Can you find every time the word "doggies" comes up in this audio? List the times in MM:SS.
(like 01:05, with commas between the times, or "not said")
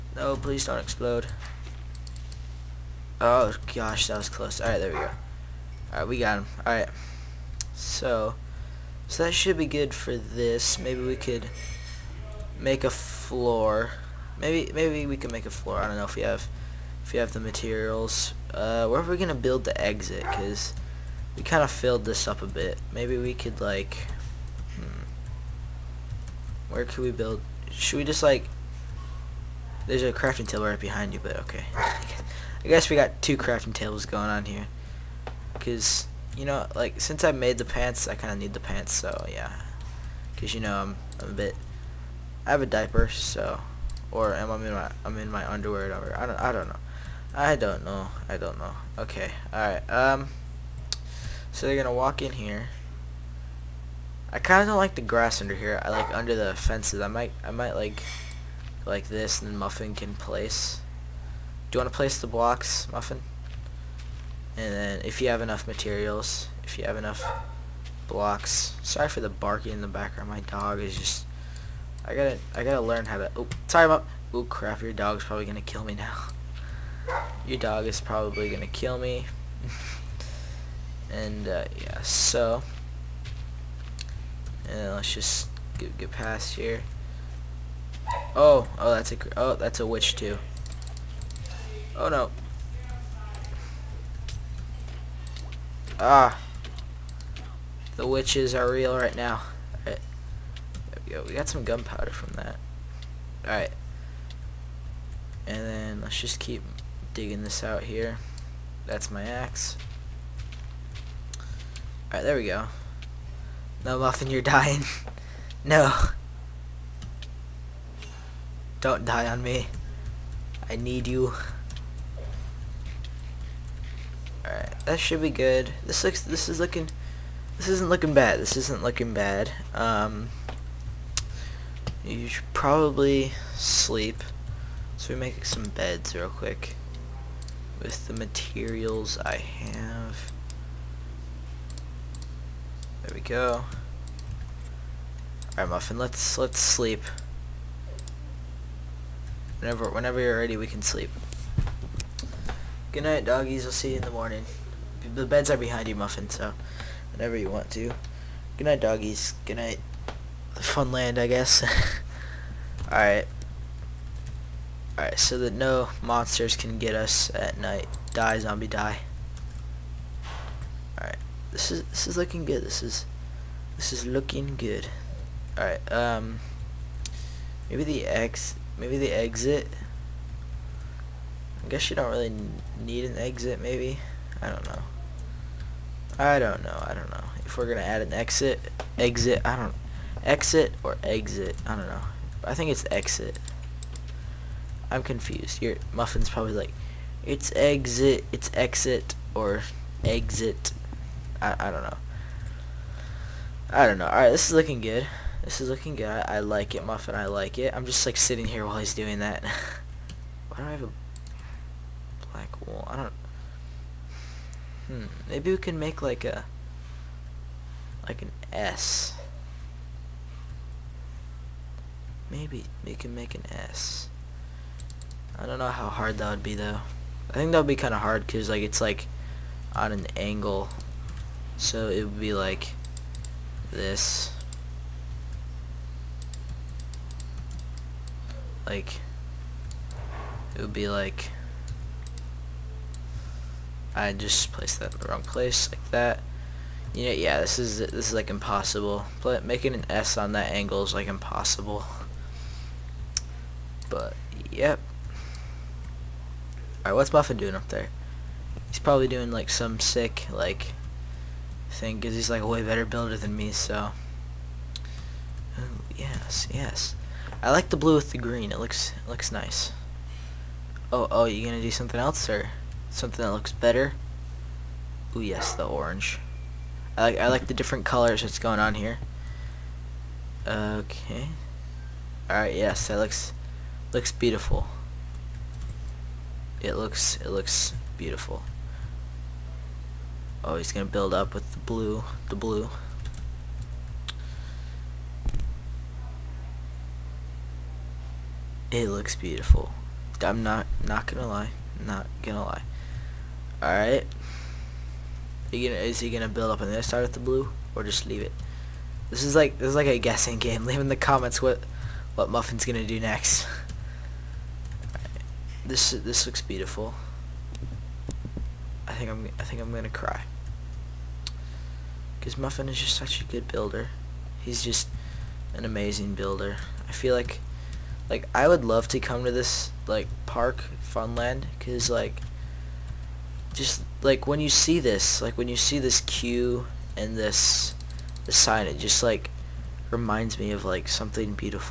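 02:33, 02:38.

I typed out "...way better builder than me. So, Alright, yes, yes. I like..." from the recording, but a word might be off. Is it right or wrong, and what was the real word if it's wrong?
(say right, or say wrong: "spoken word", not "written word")
wrong: "Ooh", not "Alright".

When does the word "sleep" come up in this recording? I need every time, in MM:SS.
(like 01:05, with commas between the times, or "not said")
02:13, 02:26, 02:30.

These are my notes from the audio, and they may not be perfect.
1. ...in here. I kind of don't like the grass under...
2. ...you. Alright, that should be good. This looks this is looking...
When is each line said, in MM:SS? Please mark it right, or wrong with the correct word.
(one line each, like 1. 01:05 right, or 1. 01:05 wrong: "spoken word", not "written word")
1. 00:52 right
2. 02:01 right.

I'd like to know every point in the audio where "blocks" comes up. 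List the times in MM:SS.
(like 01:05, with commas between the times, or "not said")
01:02, 01:08.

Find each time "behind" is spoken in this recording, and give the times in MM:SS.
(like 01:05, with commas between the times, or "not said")
00:30, 02:35.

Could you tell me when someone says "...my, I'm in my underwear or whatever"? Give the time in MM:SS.
00:44.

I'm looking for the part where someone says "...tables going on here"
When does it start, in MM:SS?
00:33.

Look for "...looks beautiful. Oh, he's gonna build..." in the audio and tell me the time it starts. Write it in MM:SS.
04:47.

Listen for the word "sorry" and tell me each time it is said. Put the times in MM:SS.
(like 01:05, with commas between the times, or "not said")
01:08, 01:13.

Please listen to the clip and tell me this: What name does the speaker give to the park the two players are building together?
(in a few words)
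Funland.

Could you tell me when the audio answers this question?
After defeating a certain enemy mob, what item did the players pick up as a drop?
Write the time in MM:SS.
01:41.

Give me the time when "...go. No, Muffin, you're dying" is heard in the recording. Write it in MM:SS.
01:52.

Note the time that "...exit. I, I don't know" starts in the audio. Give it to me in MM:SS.
03:20.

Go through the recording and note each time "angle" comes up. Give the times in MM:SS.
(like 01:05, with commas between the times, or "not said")
03:50, 04:10.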